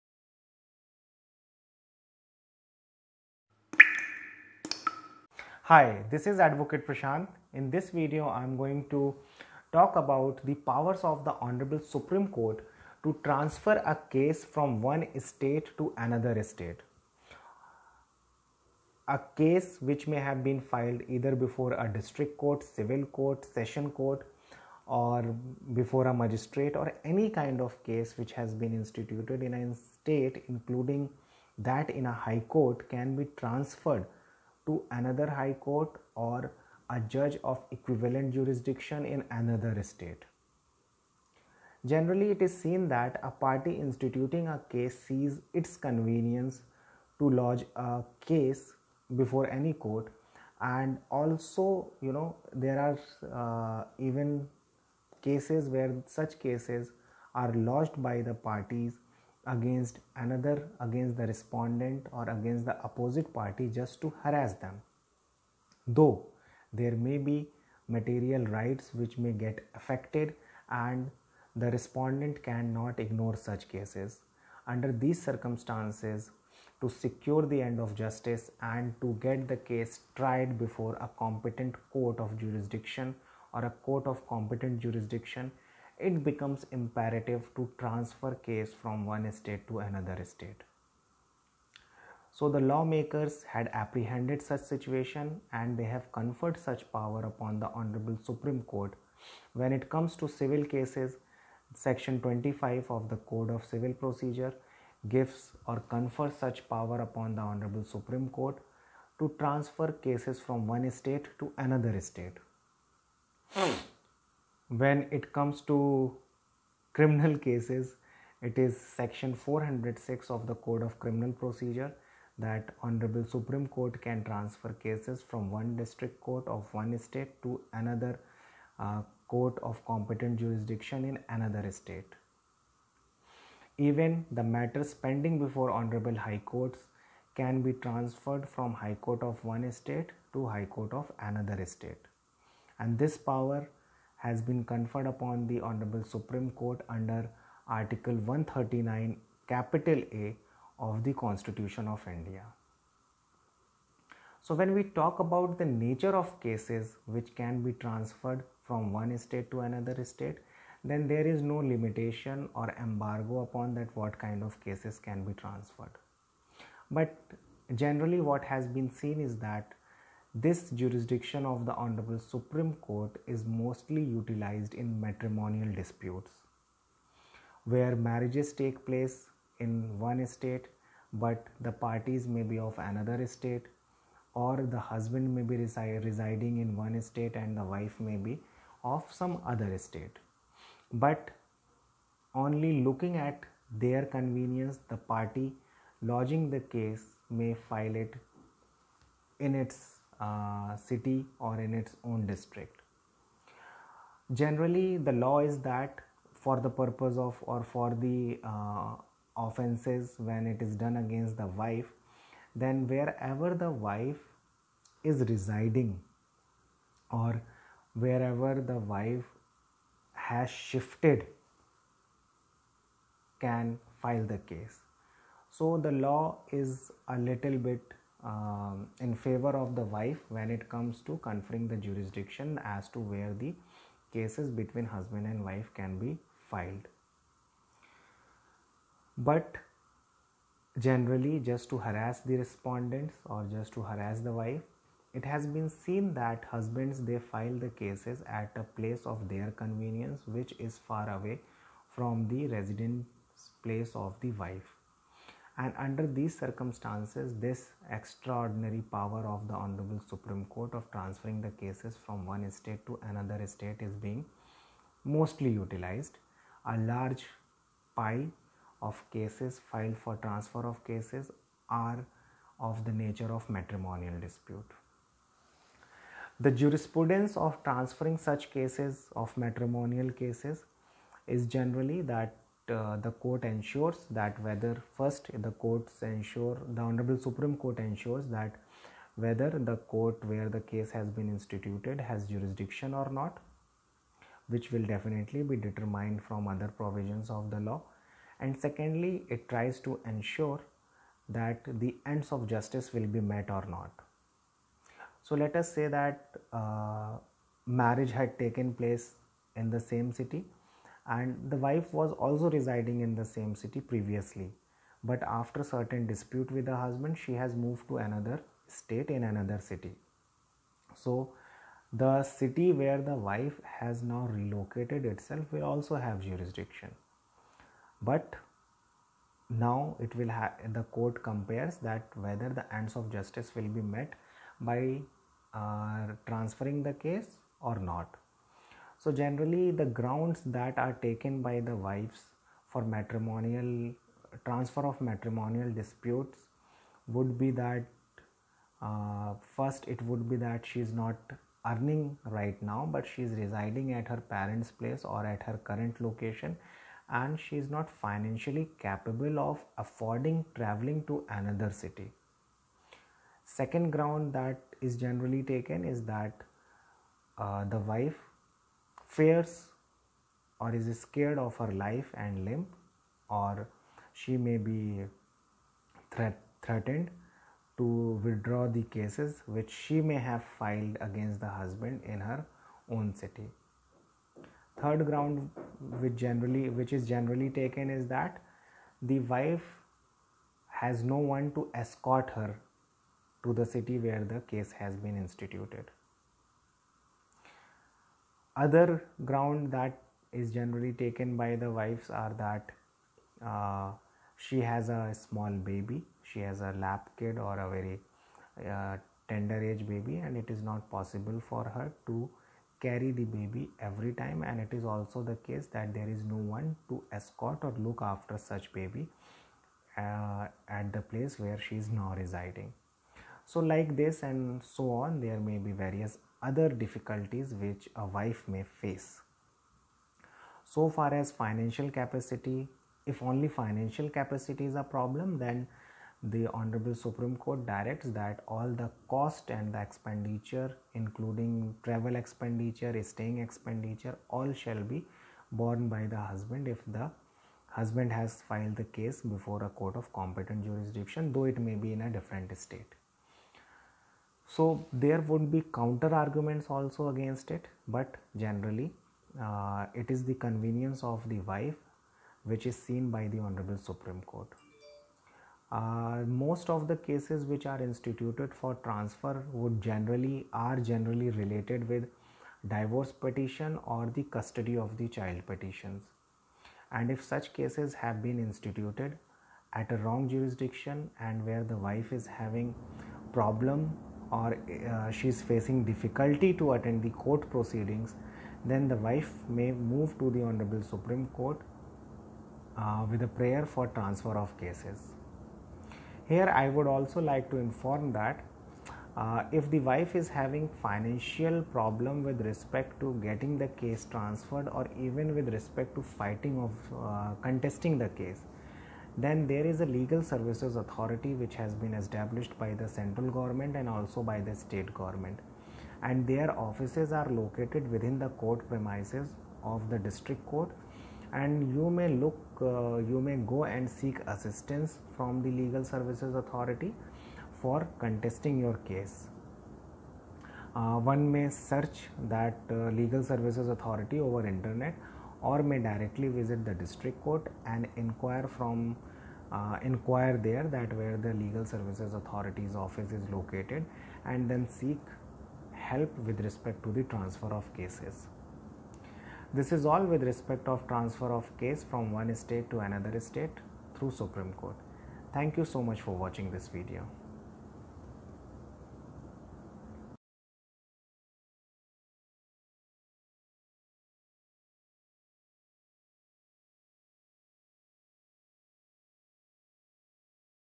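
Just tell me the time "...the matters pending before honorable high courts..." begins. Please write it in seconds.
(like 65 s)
134 s.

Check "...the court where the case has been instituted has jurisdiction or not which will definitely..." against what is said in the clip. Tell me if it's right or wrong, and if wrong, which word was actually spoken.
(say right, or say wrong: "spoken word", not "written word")
right.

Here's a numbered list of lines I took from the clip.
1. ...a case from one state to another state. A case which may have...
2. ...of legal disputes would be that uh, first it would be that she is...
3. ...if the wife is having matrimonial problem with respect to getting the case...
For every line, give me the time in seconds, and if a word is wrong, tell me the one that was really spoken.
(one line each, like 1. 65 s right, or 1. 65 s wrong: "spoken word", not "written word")
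1. 13 s right
2. 344 s wrong: "matrimonial", not "legal"
3. 499 s wrong: "financial", not "matrimonial".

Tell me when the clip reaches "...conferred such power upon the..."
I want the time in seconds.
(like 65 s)
96 s.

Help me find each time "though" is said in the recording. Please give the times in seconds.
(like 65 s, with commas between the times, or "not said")
65 s, 451 s.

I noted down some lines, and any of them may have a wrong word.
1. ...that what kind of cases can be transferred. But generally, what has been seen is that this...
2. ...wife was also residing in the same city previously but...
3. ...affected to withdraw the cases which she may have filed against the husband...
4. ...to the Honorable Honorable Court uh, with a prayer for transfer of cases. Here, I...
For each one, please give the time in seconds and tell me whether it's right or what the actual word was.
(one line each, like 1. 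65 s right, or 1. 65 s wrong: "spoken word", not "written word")
1. 163 s right
2. 311 s right
3. 376 s wrong: "threatened", not "affected"
4. 490 s wrong: "Supreme", not "Honorable".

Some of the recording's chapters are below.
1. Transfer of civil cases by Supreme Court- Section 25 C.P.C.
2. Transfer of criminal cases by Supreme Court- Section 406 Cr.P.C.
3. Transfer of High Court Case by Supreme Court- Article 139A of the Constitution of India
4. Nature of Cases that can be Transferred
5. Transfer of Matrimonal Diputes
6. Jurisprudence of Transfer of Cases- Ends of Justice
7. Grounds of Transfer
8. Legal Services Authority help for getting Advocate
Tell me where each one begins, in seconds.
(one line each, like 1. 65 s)
1. 100 s
2. 112 s
3. 132 s
4. 152 s
5. 174 s
6. 275 s
7. 340 s
8. 497 s.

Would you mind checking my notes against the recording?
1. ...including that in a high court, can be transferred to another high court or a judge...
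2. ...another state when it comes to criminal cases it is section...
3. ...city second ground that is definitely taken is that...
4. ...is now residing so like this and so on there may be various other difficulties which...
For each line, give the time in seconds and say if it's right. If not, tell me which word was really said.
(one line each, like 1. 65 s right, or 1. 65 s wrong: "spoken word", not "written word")
1. 30 s right
2. 111 s right
3. 361 s wrong: "generally", not "definitely"
4. 421 s right.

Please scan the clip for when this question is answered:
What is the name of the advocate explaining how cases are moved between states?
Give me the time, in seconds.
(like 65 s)
6 s.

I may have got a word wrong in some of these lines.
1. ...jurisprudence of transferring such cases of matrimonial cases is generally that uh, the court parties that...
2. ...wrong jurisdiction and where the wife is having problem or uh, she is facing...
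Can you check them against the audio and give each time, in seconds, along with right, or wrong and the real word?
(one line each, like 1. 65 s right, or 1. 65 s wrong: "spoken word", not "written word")
1. 276 s wrong: "ensures", not "parties"
2. 479 s right.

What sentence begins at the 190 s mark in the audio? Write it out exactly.
But only looking at their convenience, the party lodging the case may file it in its city or in its own district.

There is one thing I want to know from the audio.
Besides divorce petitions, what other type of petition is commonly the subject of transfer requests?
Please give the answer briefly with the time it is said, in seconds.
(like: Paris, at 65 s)
Custody of the child, at 474 s.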